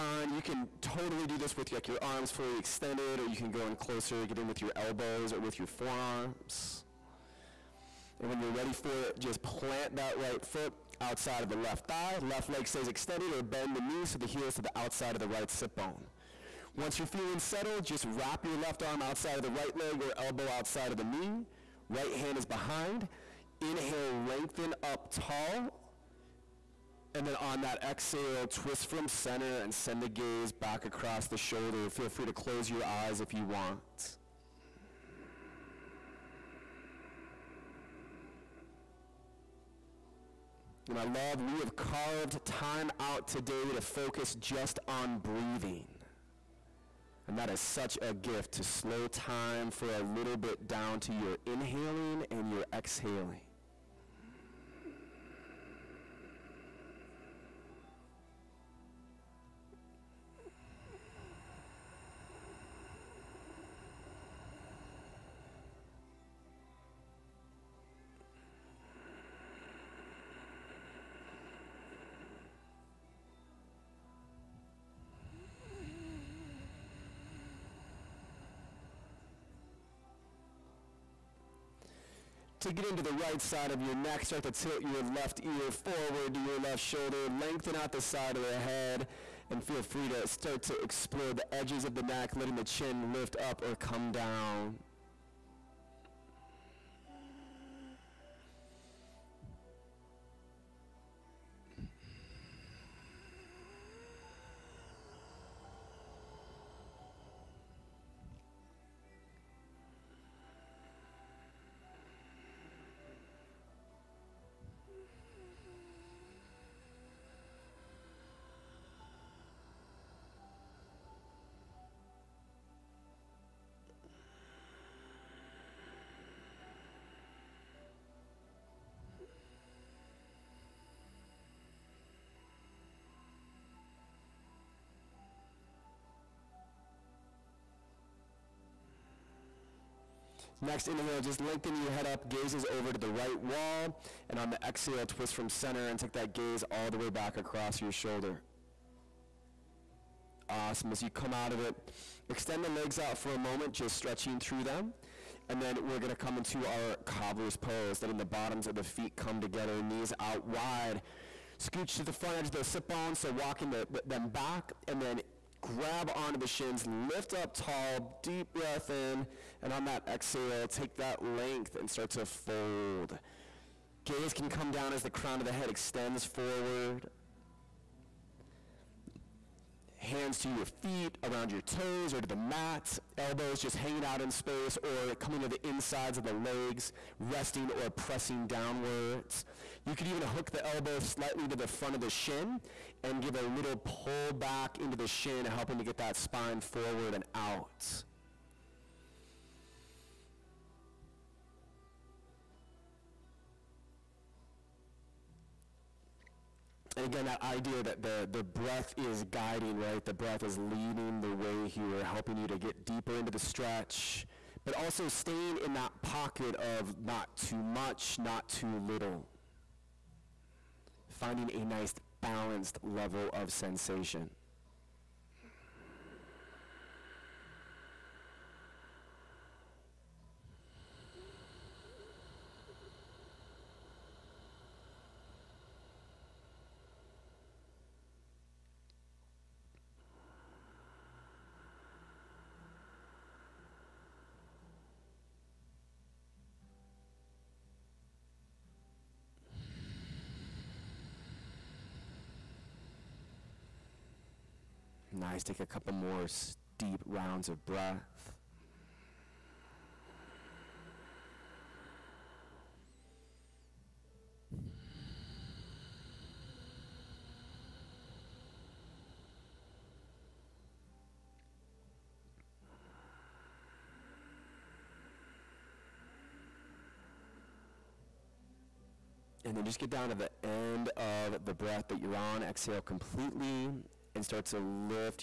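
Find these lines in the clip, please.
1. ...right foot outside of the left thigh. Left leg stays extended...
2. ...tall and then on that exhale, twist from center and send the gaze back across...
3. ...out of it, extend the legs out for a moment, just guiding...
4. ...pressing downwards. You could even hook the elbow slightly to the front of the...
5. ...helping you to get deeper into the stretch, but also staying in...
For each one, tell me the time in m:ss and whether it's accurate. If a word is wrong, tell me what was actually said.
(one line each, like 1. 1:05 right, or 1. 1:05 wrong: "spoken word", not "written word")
1. 0:10 right
2. 0:25 right
3. 2:31 wrong: "stretching", not "guiding"
4. 3:07 right
5. 3:32 right.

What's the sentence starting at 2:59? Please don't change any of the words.
Hands to your feet, around your toes, or to the mat.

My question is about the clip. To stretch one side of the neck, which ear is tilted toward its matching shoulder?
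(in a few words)
Left ear.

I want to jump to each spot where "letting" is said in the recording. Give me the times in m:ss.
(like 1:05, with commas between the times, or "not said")
1:32, 2:38.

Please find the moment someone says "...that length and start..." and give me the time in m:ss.
2:50.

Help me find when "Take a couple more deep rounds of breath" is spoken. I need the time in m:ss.
4:15.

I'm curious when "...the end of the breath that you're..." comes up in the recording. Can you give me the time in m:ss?
4:40.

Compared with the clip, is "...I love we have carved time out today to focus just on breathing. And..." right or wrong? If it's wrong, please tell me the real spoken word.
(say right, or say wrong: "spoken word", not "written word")
right.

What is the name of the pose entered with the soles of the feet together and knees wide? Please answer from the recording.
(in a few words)
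Cobbler's pose.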